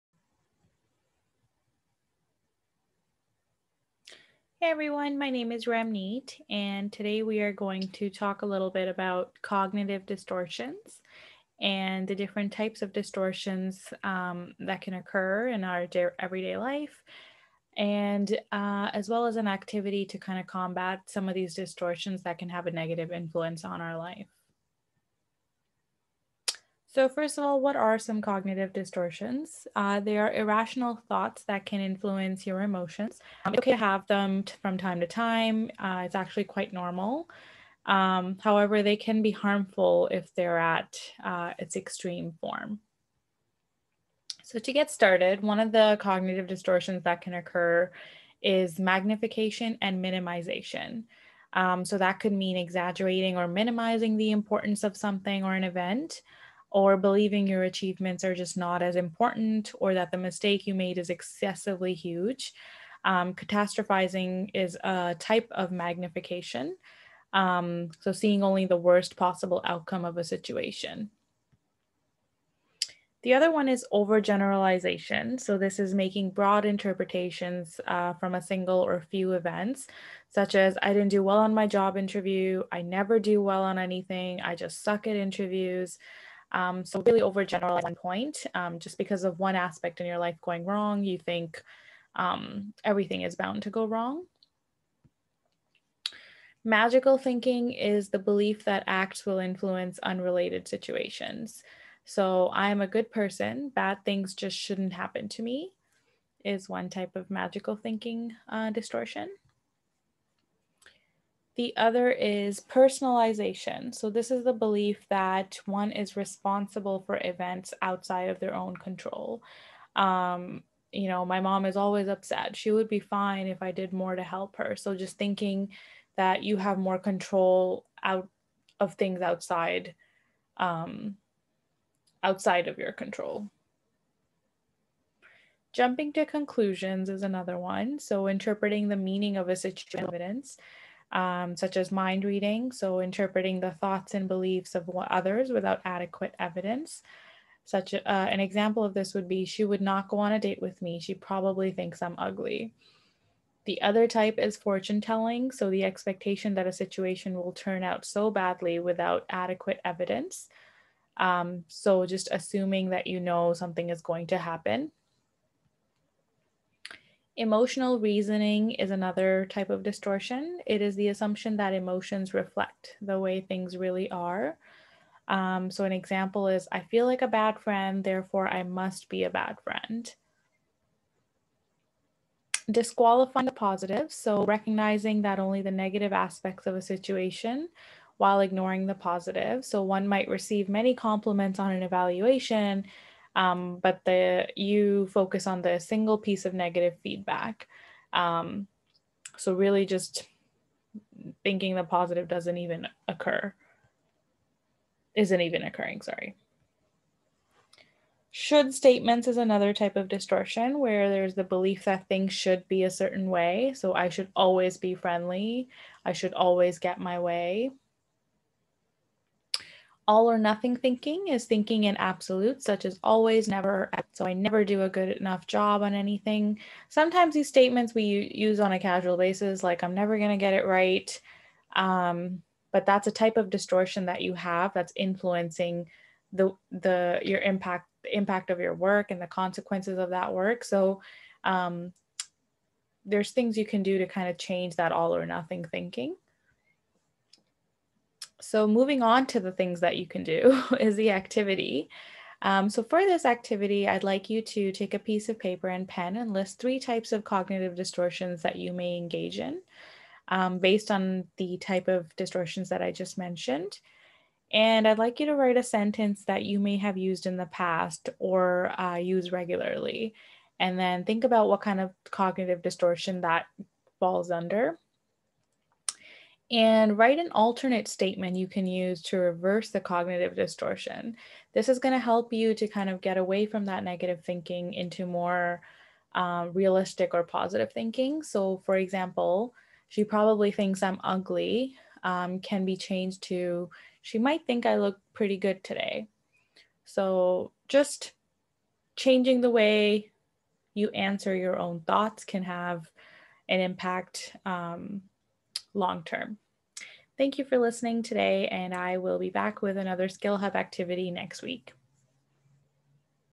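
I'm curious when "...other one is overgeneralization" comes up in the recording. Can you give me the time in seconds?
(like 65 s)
73 s.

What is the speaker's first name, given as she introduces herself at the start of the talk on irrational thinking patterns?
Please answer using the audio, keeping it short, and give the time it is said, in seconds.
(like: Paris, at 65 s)
Ramneet, at 5 s.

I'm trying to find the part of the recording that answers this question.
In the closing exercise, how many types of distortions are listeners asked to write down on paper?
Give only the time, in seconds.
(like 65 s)
256 s.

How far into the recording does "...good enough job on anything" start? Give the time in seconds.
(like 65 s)
224 s.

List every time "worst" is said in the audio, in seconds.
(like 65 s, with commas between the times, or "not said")
68 s.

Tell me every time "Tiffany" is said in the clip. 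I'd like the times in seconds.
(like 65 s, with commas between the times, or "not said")
not said.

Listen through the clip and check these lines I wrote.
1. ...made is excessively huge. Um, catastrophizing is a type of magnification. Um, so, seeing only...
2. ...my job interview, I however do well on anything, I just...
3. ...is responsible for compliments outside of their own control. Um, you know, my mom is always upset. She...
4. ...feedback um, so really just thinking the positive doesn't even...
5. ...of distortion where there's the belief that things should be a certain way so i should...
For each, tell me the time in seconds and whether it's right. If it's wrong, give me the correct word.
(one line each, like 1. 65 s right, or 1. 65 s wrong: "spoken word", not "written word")
1. 60 s right
2. 81 s wrong: "never", not "however"
3. 115 s wrong: "events", not "compliments"
4. 197 s right
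5. 209 s right.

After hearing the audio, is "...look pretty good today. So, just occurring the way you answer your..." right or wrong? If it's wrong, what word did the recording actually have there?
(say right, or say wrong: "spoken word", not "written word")
wrong: "changing", not "occurring".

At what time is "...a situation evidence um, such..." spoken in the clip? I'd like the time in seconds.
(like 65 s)
139 s.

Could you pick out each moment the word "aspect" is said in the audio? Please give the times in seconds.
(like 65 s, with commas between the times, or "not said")
89 s, 186 s.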